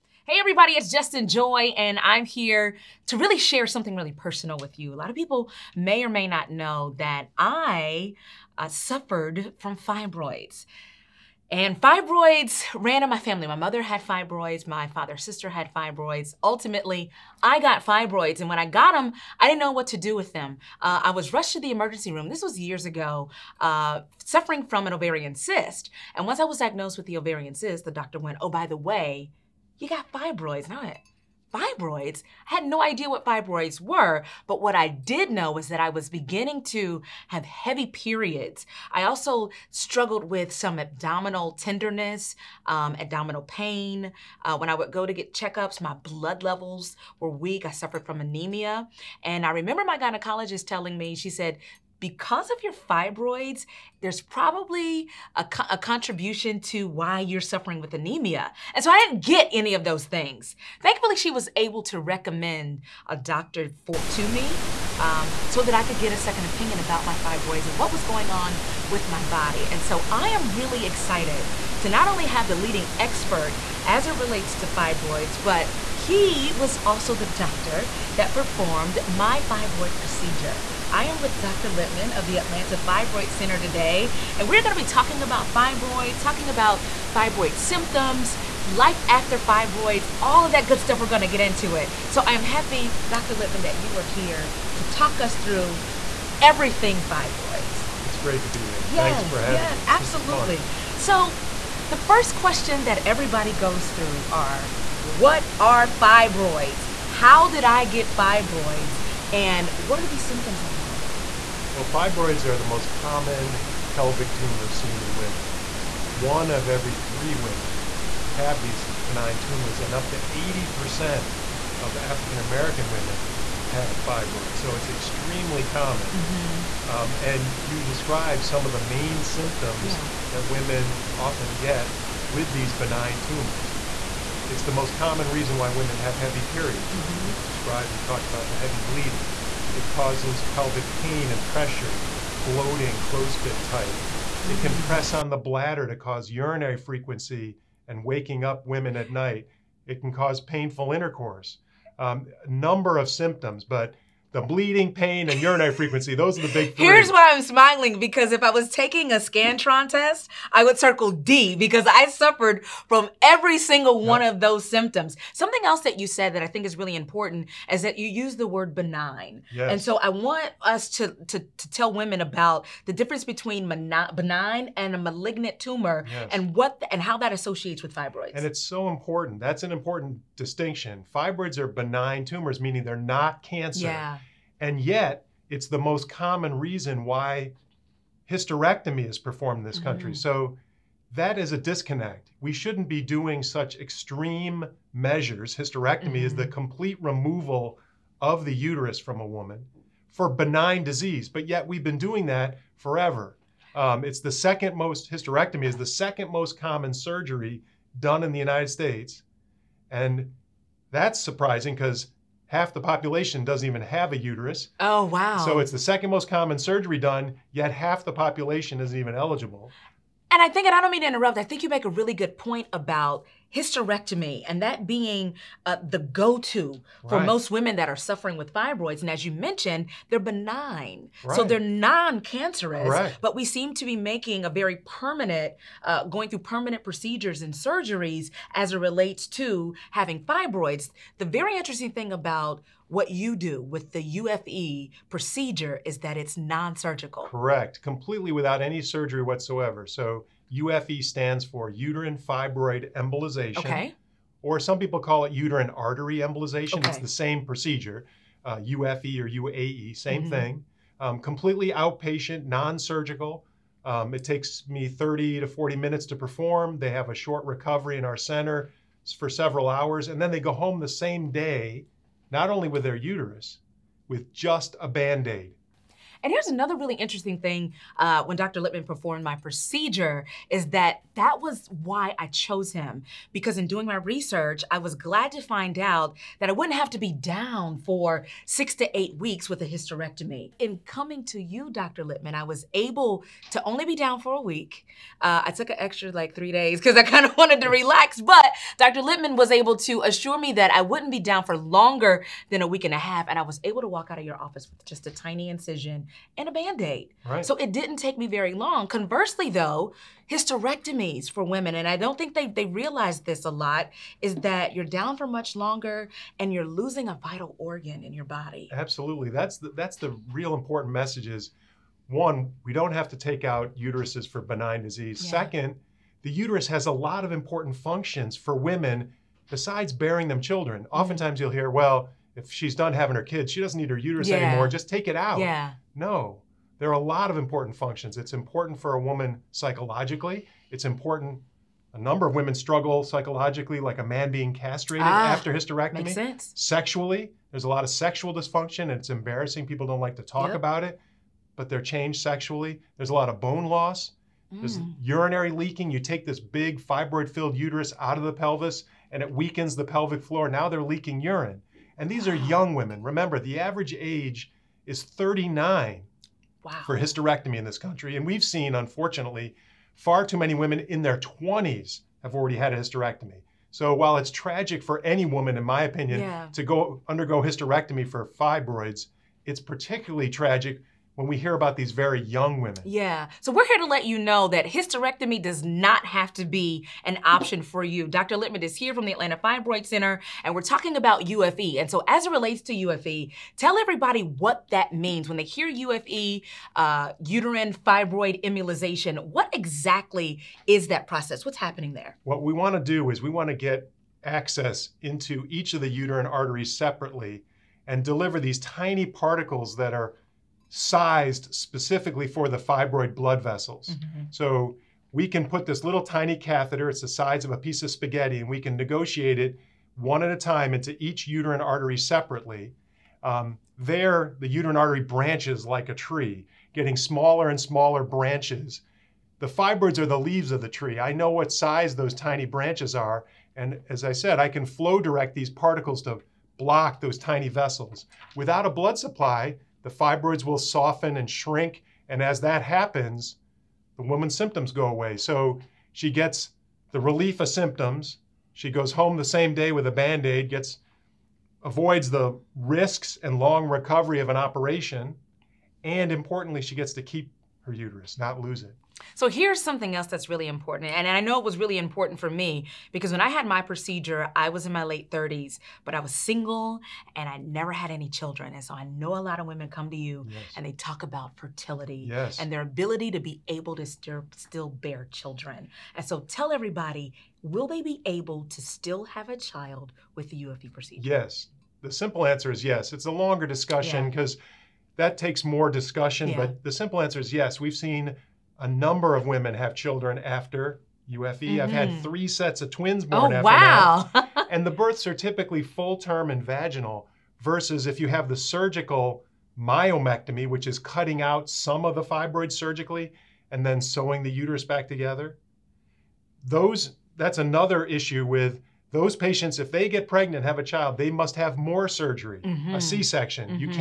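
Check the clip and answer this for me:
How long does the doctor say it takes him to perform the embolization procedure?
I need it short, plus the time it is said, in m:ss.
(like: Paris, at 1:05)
30 to 40 minutes, at 4:24.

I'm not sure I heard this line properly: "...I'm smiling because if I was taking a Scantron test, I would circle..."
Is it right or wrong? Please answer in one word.
right.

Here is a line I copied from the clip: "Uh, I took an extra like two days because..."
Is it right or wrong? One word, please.
wrong.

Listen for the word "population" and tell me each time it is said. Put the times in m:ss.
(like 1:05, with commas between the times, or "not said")
3:32, 3:38.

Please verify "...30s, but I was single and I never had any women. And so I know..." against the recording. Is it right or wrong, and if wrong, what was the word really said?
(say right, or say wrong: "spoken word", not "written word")
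wrong: "children", not "women".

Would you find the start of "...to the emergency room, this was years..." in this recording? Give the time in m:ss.
0:21.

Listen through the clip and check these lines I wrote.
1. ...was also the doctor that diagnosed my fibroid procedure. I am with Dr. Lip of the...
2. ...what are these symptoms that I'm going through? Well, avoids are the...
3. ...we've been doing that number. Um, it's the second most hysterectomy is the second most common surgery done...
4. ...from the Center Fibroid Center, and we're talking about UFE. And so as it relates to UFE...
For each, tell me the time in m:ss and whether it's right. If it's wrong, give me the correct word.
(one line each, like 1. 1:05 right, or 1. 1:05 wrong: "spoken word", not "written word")
1. 1:16 wrong: "performed", not "diagnosed"
2. 1:49 wrong: "fibroids", not "avoids"
3. 3:21 wrong: "forever", not "number"
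4. 6:28 wrong: "Atlanta", not "Center".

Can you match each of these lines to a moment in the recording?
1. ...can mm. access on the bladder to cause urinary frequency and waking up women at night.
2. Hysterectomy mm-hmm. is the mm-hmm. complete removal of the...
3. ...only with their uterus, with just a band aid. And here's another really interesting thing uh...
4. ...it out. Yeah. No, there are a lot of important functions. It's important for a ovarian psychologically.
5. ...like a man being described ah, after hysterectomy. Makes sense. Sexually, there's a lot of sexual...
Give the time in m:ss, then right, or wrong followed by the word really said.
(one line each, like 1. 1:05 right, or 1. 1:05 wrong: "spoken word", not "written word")
1. 2:24 wrong: "press", not "access"
2. 3:15 right
3. 4:32 right
4. 5:35 wrong: "woman", not "ovarian"
5. 5:43 wrong: "castrated", not "described".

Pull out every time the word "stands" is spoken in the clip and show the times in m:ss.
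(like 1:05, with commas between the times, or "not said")
4:11.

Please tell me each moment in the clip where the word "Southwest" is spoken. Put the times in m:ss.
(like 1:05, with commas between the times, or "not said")
not said.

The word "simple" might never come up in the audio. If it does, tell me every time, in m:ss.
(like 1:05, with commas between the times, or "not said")
8:01, 8:06.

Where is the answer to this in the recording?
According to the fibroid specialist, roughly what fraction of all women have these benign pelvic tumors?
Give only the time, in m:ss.
1:56.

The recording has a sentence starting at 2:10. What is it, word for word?
that women often get with these benign tumors.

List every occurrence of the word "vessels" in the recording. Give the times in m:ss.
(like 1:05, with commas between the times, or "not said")
6:53, 7:17.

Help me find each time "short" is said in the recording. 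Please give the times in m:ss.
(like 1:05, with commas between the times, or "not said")
4:27.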